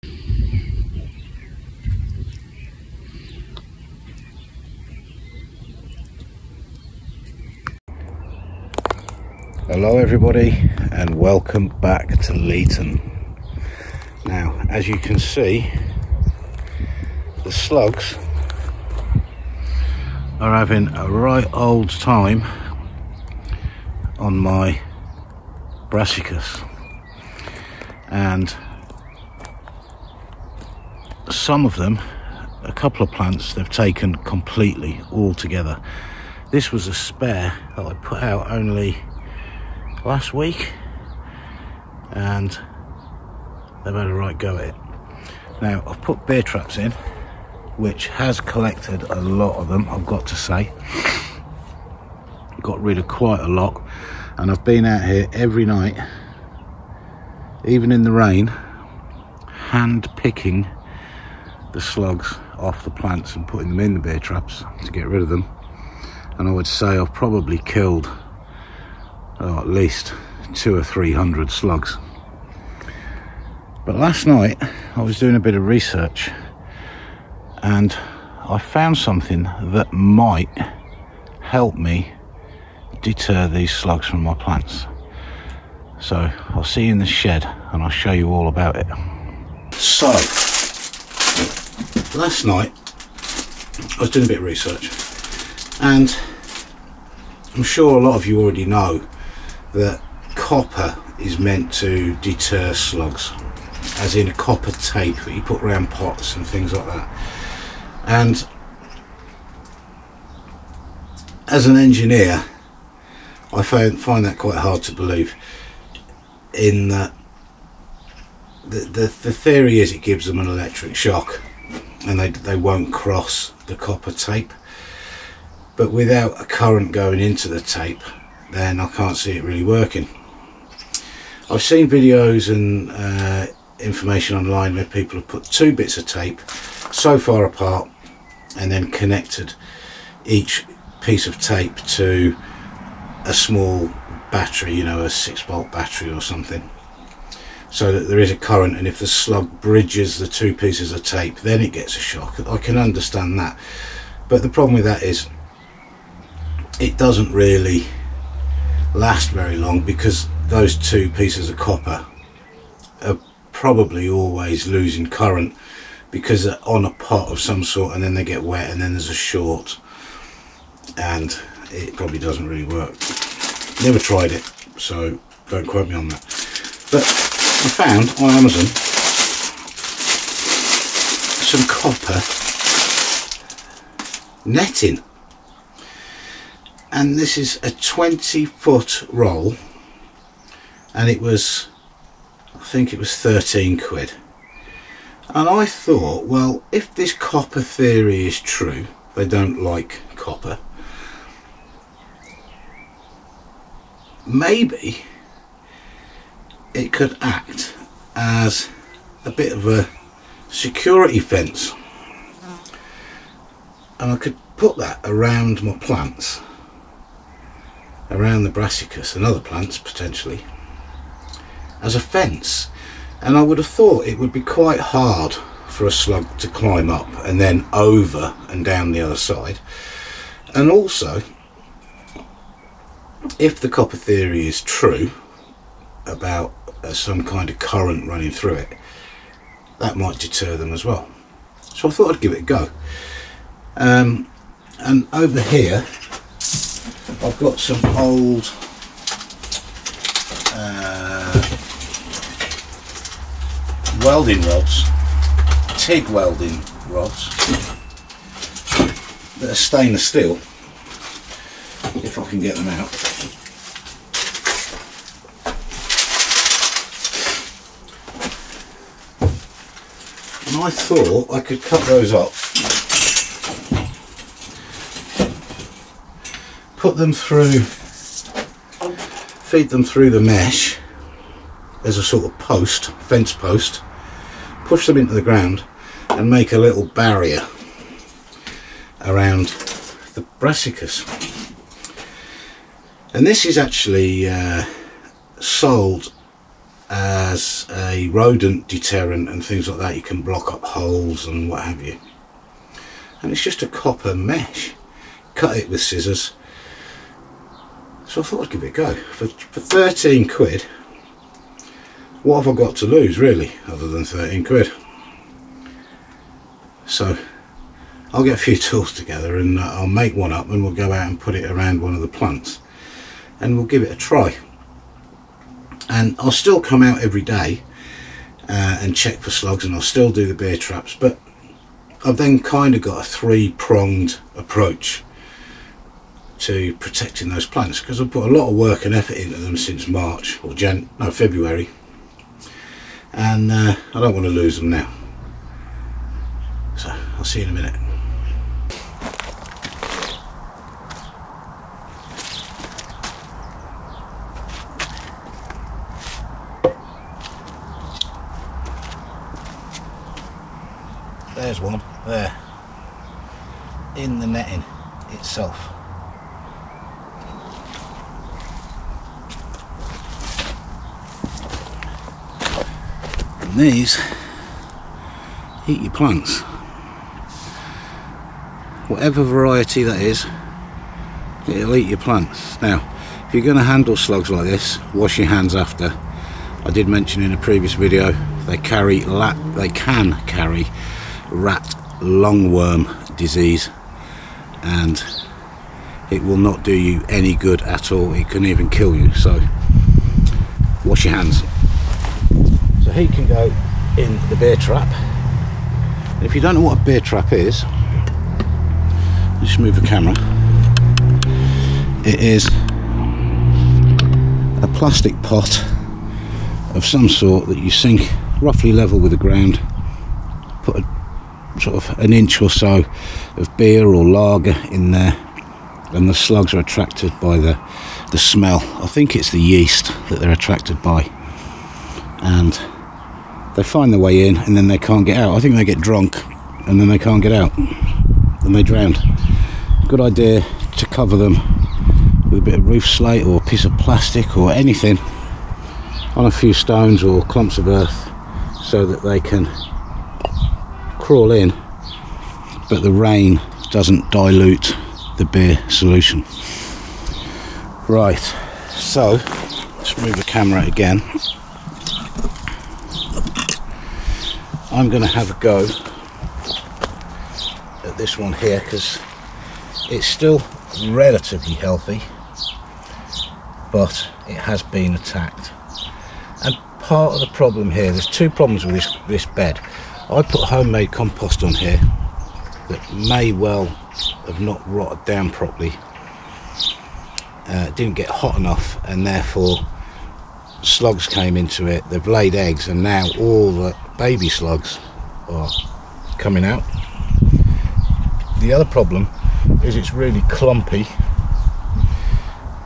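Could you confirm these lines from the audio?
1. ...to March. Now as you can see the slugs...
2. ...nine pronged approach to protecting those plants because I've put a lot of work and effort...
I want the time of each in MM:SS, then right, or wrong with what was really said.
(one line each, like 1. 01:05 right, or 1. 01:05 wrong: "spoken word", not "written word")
1. 00:12 wrong: "Leaton", not "March"
2. 05:33 wrong: "three", not "nine".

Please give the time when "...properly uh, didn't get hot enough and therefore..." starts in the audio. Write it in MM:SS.
08:05.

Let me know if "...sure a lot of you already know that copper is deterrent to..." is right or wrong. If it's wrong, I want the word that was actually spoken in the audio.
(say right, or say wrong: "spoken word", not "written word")
wrong: "meant", not "deterrent".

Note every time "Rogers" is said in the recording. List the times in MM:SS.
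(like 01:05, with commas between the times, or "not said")
not said.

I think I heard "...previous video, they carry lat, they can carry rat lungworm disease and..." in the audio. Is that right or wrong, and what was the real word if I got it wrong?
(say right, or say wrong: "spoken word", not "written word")
right.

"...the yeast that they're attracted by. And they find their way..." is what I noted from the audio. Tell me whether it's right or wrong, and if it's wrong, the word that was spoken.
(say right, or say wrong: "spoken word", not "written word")
right.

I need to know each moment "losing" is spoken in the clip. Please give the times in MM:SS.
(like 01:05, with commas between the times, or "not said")
02:44.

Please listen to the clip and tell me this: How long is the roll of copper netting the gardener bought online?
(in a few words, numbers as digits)
20 foot.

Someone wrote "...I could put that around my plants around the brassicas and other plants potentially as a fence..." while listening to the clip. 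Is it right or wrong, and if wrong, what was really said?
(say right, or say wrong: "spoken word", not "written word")
right.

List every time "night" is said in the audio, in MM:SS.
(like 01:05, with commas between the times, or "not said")
00:55, 01:14, 01:32.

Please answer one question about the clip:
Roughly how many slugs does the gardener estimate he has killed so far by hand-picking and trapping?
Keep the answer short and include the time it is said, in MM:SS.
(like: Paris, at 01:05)
200-300, at 01:10.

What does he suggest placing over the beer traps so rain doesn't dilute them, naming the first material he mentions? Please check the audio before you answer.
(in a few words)
Roof slate.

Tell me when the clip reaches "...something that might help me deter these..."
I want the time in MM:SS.
01:18.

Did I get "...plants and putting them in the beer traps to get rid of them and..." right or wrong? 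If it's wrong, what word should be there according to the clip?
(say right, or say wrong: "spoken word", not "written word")
right.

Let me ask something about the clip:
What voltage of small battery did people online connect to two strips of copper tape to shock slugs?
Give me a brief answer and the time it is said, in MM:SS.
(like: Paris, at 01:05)
6 volt, at 02:25.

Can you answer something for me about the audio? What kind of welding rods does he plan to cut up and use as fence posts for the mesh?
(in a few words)
TIG welding rods.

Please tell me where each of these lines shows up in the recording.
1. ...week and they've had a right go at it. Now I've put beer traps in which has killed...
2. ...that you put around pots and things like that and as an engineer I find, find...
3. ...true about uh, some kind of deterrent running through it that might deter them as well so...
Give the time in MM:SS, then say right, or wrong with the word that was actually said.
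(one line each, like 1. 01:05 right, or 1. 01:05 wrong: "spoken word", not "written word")
1. 00:40 wrong: "collected", not "killed"
2. 01:45 right
3. 03:54 wrong: "current", not "deterrent".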